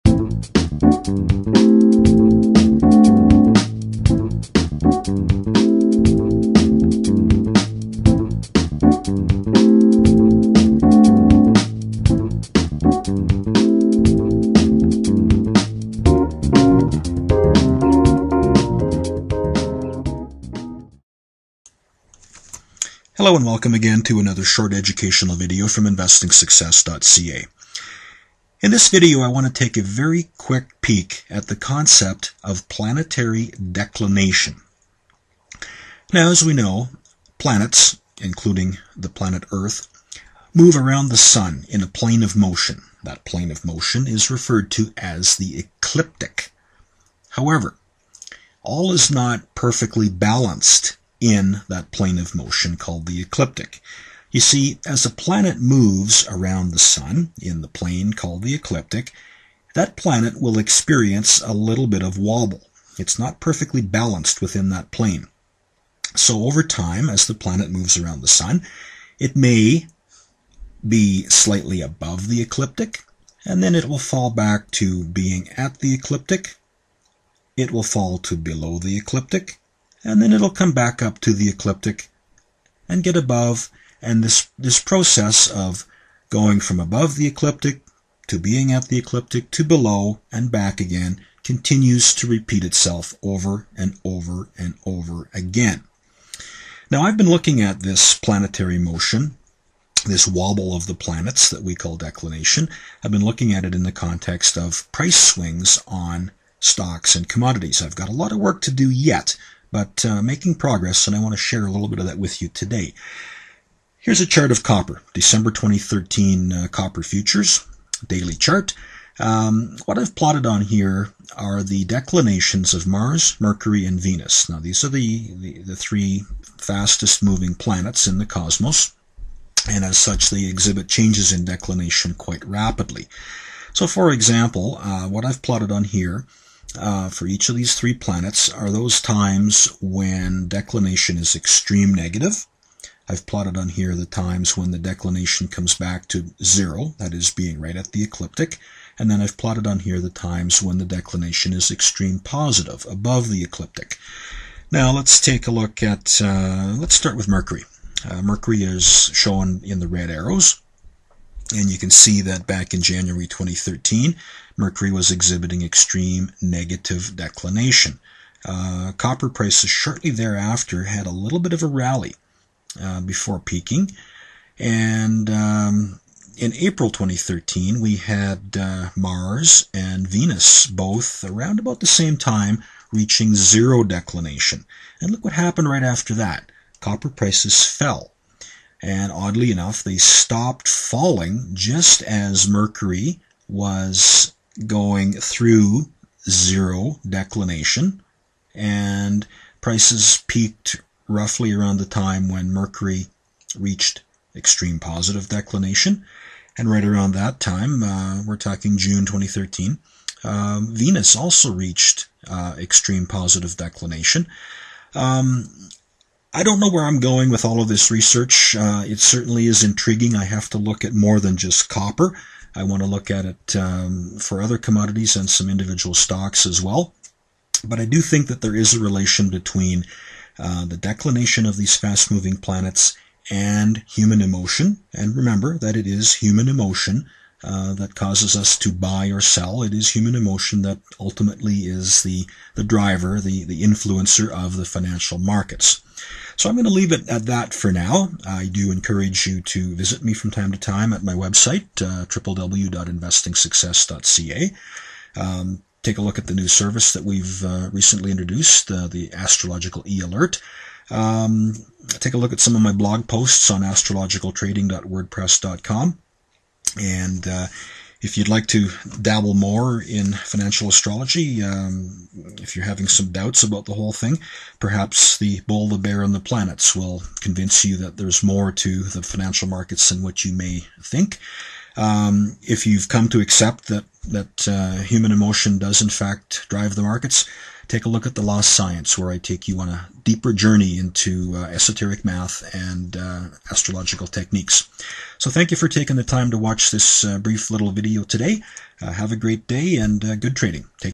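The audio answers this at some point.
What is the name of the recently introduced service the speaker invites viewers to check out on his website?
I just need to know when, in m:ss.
4:19.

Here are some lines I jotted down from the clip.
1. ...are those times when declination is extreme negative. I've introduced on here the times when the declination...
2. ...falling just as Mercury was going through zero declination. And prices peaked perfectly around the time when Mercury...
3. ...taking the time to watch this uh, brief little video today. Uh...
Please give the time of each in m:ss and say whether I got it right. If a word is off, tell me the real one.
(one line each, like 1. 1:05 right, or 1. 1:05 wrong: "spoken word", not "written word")
1. 2:18 wrong: "plotted", not "introduced"
2. 3:10 wrong: "roughly", not "perfectly"
3. 4:55 right.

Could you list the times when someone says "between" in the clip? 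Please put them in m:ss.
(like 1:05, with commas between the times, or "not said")
3:49.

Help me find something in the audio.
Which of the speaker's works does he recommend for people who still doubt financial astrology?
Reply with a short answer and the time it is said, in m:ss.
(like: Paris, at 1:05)
The Bull, the Bear, and the Planets, at 4:35.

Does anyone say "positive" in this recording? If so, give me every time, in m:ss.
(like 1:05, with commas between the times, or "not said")
2:32, 3:24, 3:33.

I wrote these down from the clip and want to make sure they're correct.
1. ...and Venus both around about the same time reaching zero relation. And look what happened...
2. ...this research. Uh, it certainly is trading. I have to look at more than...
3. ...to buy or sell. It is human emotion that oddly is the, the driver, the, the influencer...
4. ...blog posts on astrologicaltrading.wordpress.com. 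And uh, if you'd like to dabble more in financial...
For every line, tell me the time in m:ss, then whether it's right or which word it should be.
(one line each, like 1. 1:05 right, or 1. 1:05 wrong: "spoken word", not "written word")
1. 2:59 wrong: "declination", not "relation"
2. 3:37 wrong: "intriguing", not "trading"
3. 3:58 wrong: "ultimately", not "oddly"
4. 4:22 right.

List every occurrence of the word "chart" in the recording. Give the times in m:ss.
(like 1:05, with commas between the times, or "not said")
1:54, 1:58.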